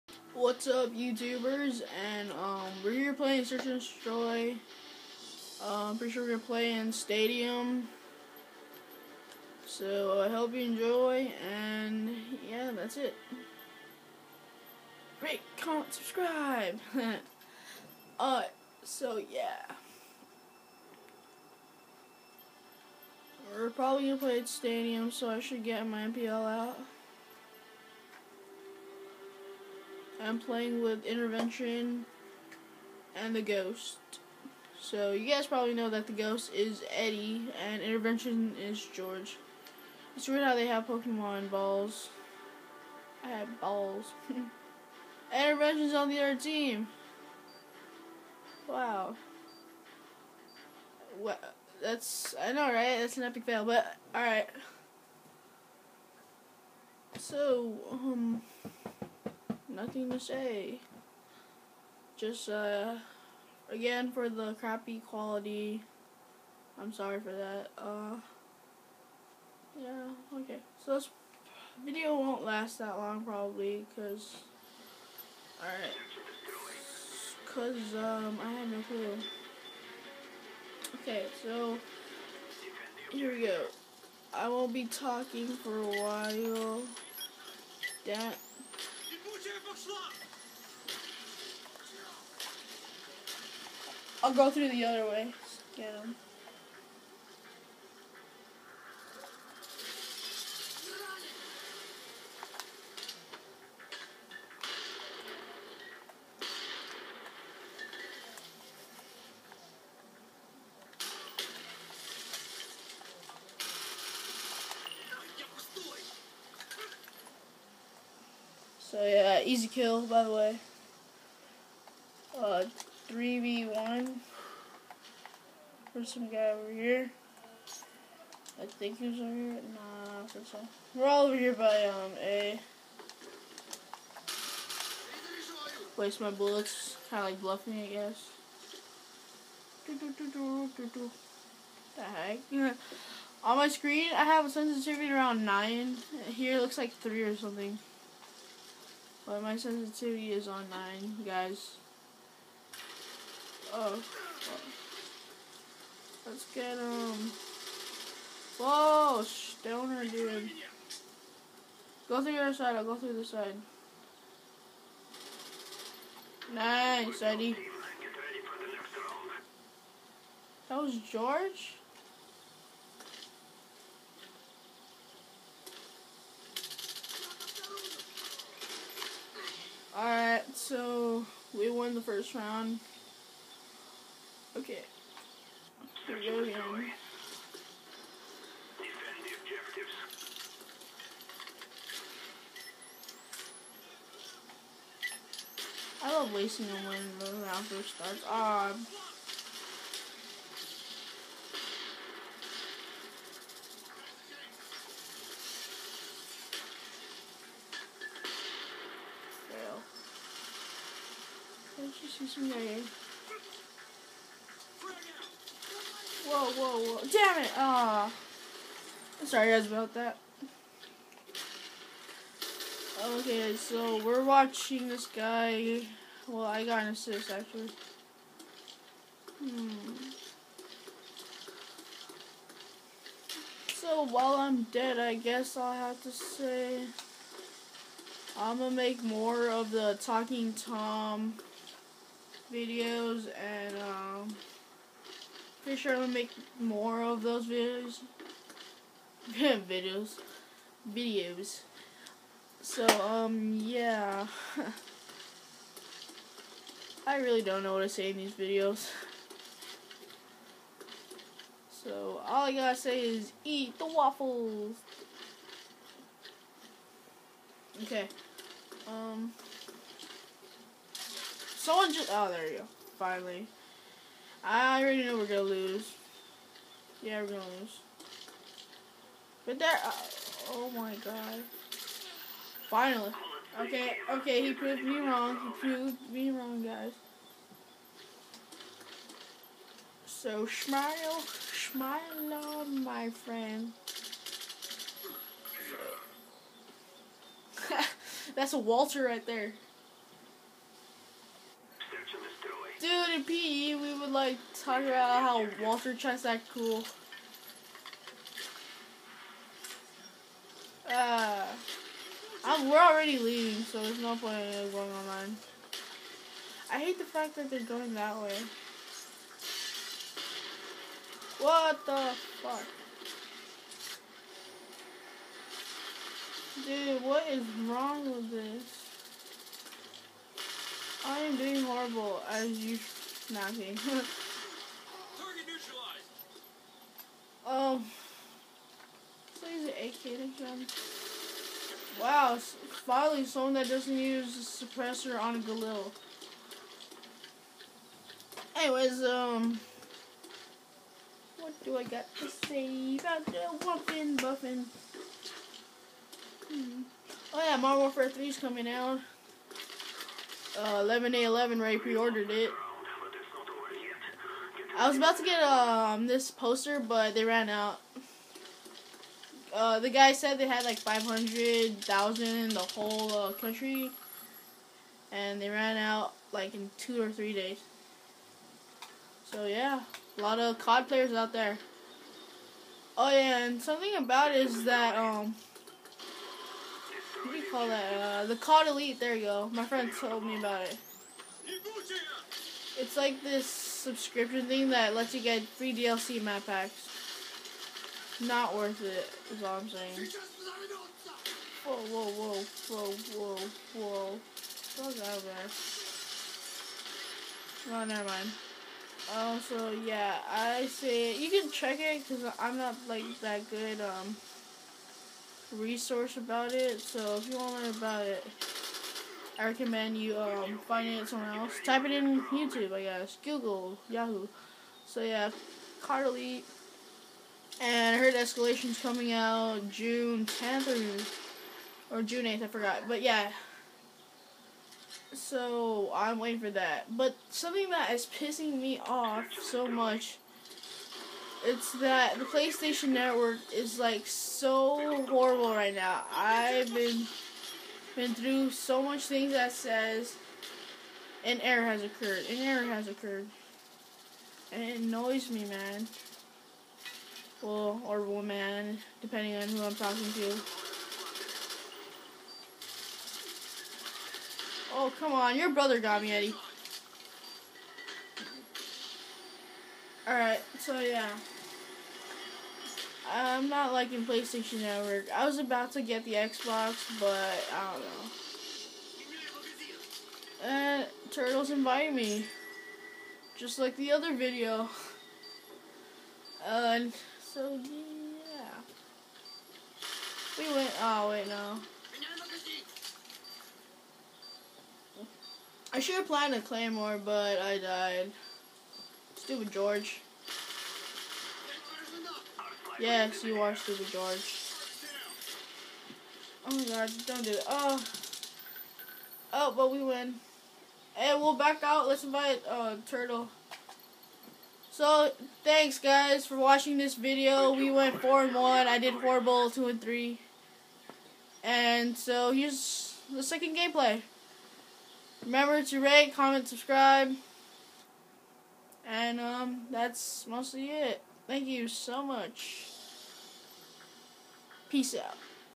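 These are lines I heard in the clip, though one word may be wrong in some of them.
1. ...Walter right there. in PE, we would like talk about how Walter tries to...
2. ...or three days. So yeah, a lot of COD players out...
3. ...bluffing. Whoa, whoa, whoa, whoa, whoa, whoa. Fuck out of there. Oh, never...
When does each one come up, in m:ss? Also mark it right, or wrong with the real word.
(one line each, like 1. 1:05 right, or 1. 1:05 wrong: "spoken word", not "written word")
1. 4:58 right
2. 6:16 right
3. 6:39 wrong: "saying", not "bluffing".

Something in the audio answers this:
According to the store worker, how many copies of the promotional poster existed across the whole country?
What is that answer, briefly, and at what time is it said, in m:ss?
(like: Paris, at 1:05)
500,000, at 6:10.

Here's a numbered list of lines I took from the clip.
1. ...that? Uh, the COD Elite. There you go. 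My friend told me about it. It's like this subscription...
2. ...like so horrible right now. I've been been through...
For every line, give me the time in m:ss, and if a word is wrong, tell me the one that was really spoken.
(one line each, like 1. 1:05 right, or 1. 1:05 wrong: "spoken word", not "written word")
1. 6:27 right
2. 7:23 right.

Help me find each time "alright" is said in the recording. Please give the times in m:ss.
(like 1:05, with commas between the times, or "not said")
1:15, 2:59, 7:50.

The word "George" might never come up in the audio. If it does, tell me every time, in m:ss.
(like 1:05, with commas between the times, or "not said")
0:38, 2:51, 8:19, 8:23.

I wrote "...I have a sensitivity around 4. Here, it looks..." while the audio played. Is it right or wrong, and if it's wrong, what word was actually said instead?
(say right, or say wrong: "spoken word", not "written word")
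wrong: "9", not "4".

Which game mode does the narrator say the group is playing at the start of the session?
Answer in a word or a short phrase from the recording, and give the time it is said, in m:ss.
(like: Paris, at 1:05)
Search and Destroy, at 0:03.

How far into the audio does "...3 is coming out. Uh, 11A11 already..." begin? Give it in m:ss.
5:58.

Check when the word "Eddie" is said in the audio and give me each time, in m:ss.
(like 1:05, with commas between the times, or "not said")
0:36, 2:47, 7:46.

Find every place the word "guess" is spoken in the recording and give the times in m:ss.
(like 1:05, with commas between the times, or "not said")
2:17, 3:55, 7:02.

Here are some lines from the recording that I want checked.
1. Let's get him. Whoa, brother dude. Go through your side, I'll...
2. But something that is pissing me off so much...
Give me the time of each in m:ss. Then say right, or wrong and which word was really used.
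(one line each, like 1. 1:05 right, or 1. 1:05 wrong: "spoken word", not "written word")
1. 2:36 wrong: "stoner", not "brother"
2. 7:16 right.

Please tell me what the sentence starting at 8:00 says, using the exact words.
And uh, turtles invite me, just like the other video.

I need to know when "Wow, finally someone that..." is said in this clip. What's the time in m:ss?
5:41.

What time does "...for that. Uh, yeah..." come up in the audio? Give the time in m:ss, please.
1:07.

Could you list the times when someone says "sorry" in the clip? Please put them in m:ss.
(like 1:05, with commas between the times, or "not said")
1:06, 3:39.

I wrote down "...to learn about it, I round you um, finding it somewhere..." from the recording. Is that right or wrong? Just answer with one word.
wrong.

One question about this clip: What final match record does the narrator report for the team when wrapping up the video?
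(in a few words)
4 and 1.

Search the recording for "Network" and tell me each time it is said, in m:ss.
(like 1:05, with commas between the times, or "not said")
7:22, 7:54.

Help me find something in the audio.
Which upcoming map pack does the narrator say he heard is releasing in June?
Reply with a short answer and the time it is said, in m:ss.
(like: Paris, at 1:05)
Escalation, at 7:08.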